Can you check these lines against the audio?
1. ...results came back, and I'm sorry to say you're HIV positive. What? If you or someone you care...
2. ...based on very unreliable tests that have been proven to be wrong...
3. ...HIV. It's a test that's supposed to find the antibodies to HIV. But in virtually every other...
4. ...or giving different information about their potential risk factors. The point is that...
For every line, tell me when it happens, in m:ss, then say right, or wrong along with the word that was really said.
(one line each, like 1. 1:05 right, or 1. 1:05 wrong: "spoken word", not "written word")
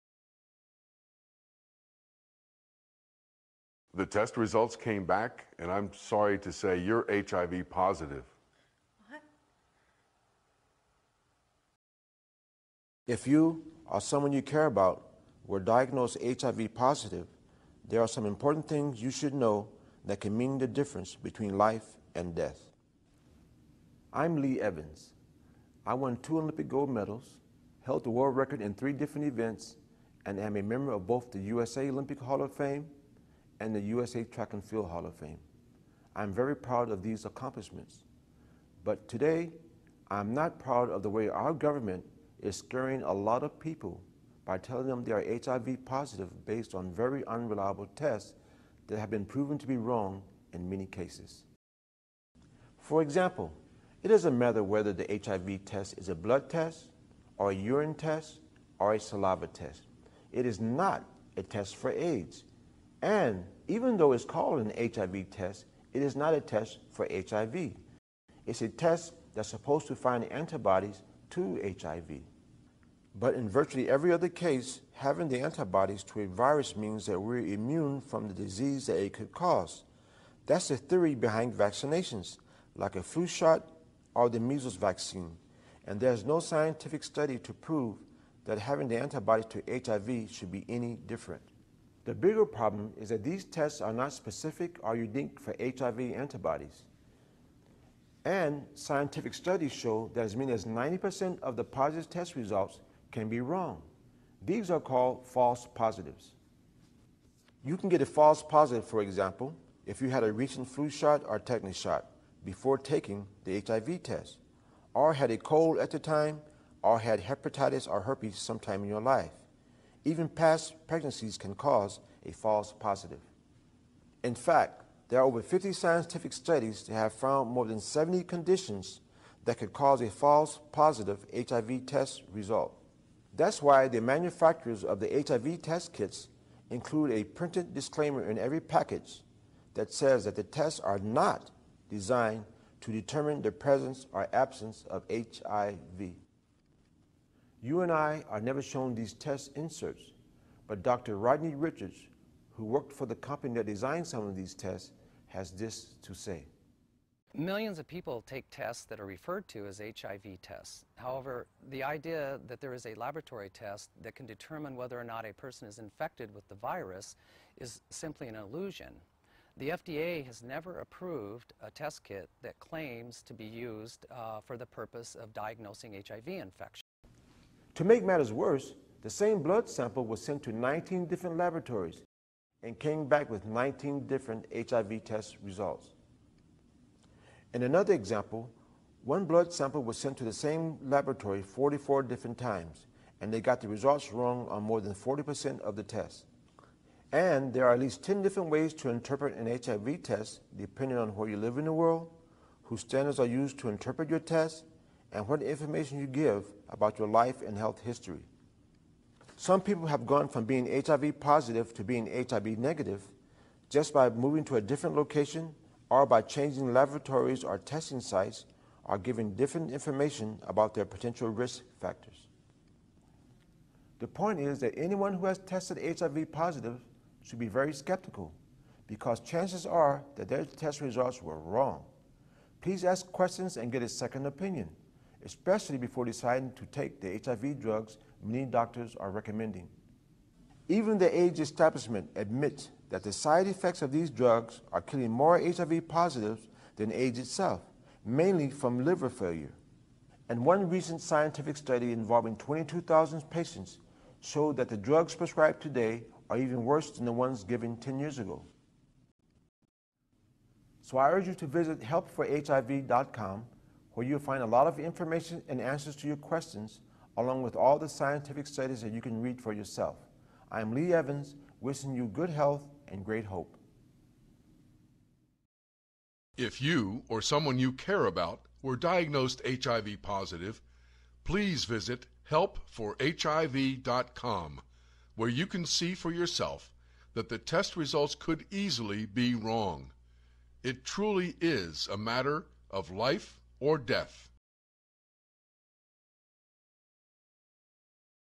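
1. 0:04 right
2. 0:46 right
3. 1:07 right
4. 3:38 right.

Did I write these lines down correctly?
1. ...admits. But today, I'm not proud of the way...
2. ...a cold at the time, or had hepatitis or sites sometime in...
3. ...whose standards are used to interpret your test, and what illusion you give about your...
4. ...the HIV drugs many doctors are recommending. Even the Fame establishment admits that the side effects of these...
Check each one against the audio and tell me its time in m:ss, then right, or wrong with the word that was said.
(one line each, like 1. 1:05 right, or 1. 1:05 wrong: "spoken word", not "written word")
1. 0:37 wrong: "accomplishments", not "admits"
2. 1:55 wrong: "herpes", not "sites"
3. 3:22 wrong: "information", not "illusion"
4. 3:56 wrong: "AIDS", not "Fame".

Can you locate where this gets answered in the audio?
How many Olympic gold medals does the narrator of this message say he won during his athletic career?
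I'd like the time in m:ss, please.
0:26.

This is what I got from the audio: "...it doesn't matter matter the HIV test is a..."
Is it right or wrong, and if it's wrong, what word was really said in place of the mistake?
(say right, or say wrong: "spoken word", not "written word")
wrong: "whether", not "matter".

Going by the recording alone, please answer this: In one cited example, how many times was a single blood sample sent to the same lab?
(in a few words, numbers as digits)
44.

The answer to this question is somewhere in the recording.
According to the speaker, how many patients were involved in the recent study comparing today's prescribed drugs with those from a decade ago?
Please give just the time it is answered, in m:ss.
4:12.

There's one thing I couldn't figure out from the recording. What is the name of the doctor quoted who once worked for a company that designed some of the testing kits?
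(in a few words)
Rodney Richards.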